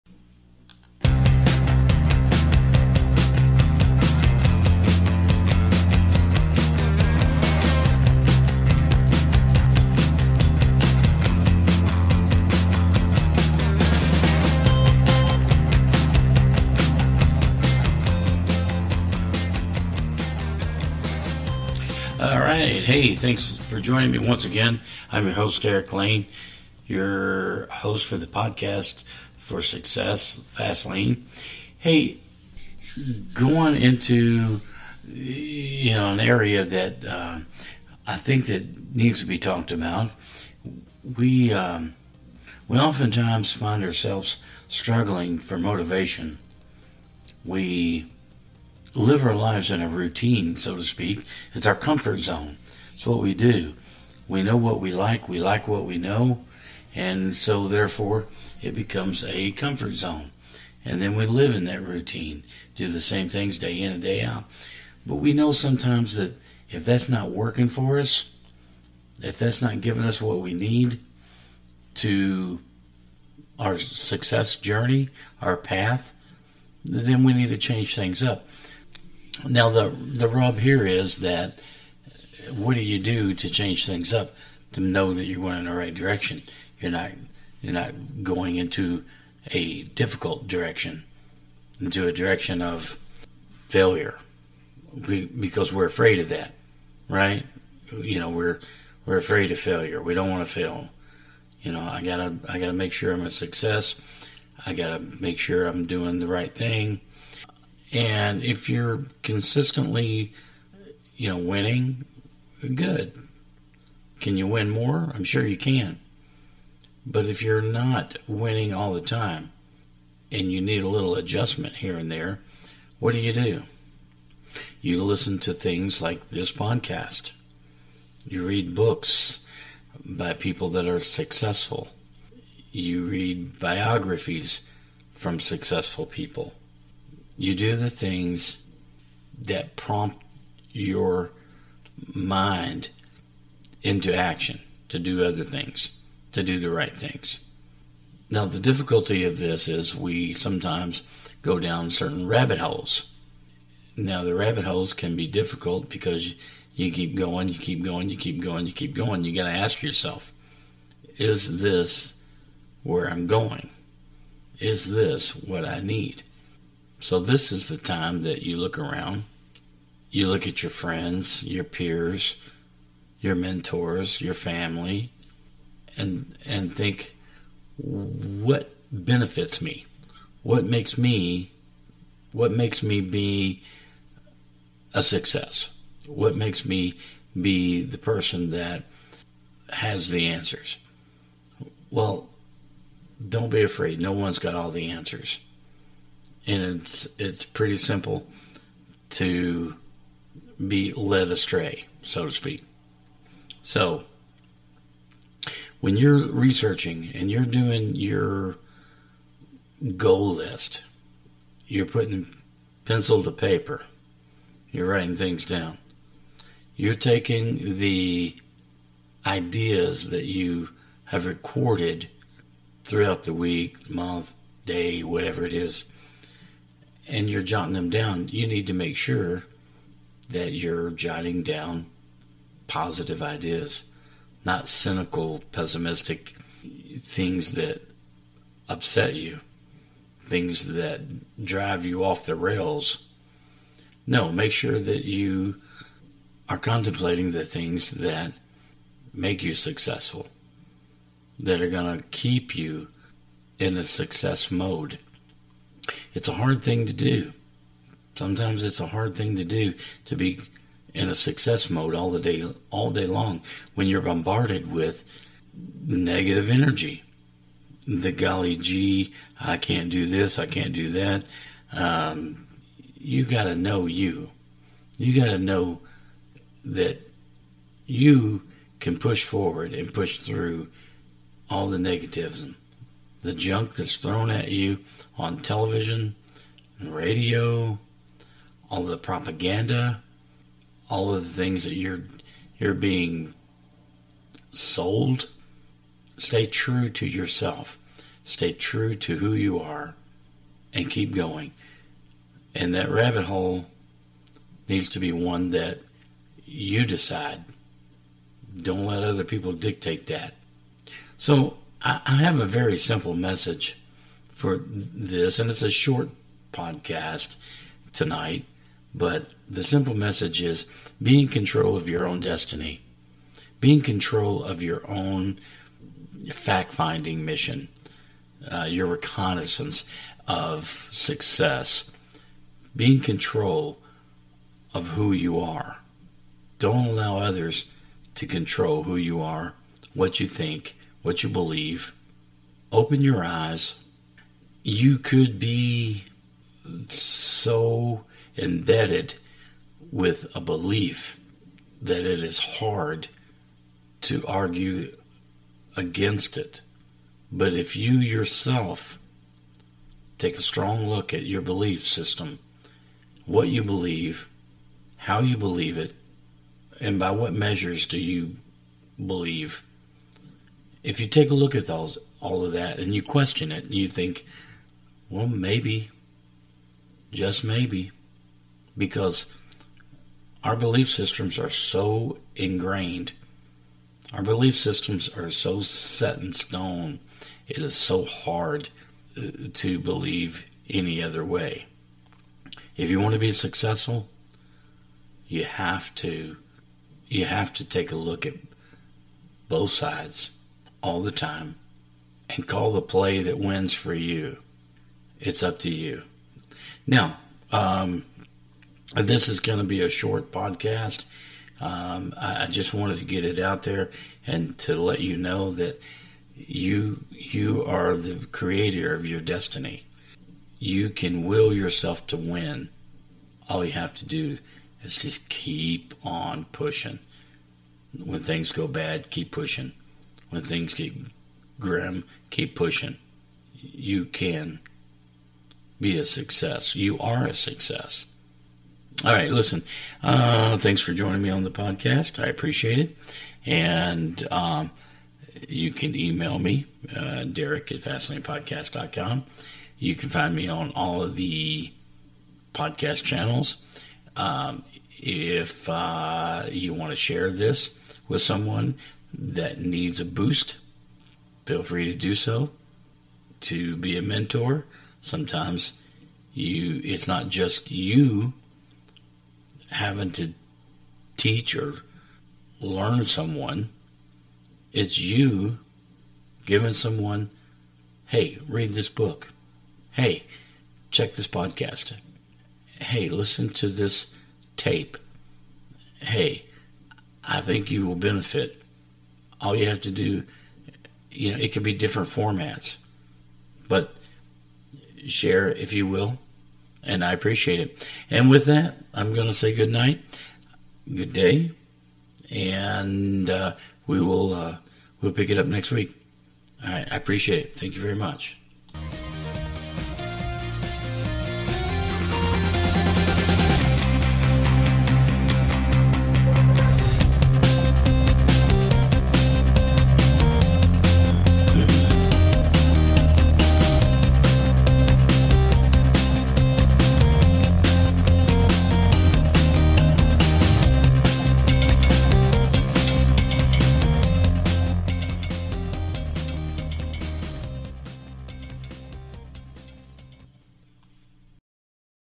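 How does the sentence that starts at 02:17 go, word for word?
You do the things that prompt your mind into action to do other things, to do the right things.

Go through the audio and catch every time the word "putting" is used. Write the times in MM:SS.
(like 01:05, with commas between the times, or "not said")
03:31.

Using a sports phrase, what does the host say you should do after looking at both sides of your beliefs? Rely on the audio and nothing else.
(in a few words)
Call the play.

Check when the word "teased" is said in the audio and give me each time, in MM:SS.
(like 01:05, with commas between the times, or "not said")
not said.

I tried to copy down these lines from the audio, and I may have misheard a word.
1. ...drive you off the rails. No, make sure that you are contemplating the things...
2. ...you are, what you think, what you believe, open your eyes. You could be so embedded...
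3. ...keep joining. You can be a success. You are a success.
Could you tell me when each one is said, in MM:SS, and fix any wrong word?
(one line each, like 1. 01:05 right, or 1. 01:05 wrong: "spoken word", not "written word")
1. 04:01 right
2. 05:38 right
3. 07:12 wrong: "pushing", not "joining".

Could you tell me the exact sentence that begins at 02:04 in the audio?
You listen to things like this podcast.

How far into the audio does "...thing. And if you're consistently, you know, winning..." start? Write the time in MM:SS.
01:46.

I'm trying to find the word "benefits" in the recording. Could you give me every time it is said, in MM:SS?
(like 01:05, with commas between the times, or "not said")
02:58, 08:07.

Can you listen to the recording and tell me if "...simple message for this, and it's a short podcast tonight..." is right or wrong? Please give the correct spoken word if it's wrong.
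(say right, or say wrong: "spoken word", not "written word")
right.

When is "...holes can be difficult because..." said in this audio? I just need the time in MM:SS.
02:34.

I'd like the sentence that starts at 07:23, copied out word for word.
And um, you can email me, uh, Derek at FascinatingPodcast.com.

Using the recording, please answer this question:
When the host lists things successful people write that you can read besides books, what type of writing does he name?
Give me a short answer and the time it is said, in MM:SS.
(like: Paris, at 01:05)
Biographies, at 02:13.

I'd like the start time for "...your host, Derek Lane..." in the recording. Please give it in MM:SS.
00:25.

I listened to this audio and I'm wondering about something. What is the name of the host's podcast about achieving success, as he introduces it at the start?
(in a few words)
Fast Lane.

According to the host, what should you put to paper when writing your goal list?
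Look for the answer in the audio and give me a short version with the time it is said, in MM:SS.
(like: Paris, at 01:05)
Pencil, at 03:32.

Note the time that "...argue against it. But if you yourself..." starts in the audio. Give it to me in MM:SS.
05:54.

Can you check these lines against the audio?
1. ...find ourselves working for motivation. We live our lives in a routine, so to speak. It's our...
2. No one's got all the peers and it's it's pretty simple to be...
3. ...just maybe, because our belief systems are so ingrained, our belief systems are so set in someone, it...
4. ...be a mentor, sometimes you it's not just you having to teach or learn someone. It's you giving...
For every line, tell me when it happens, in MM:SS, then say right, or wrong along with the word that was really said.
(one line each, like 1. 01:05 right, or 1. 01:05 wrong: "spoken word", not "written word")
1. 00:43 wrong: "struggling", not "working"
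2. 03:13 wrong: "answers", not "peers"
3. 06:17 wrong: "stone", not "someone"
4. 07:43 right.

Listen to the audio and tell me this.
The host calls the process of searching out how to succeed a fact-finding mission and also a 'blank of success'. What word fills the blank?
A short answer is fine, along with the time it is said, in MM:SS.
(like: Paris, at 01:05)
Reconnaissance, at 05:28.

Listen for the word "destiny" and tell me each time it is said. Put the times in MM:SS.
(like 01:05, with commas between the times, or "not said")
05:22, 06:59.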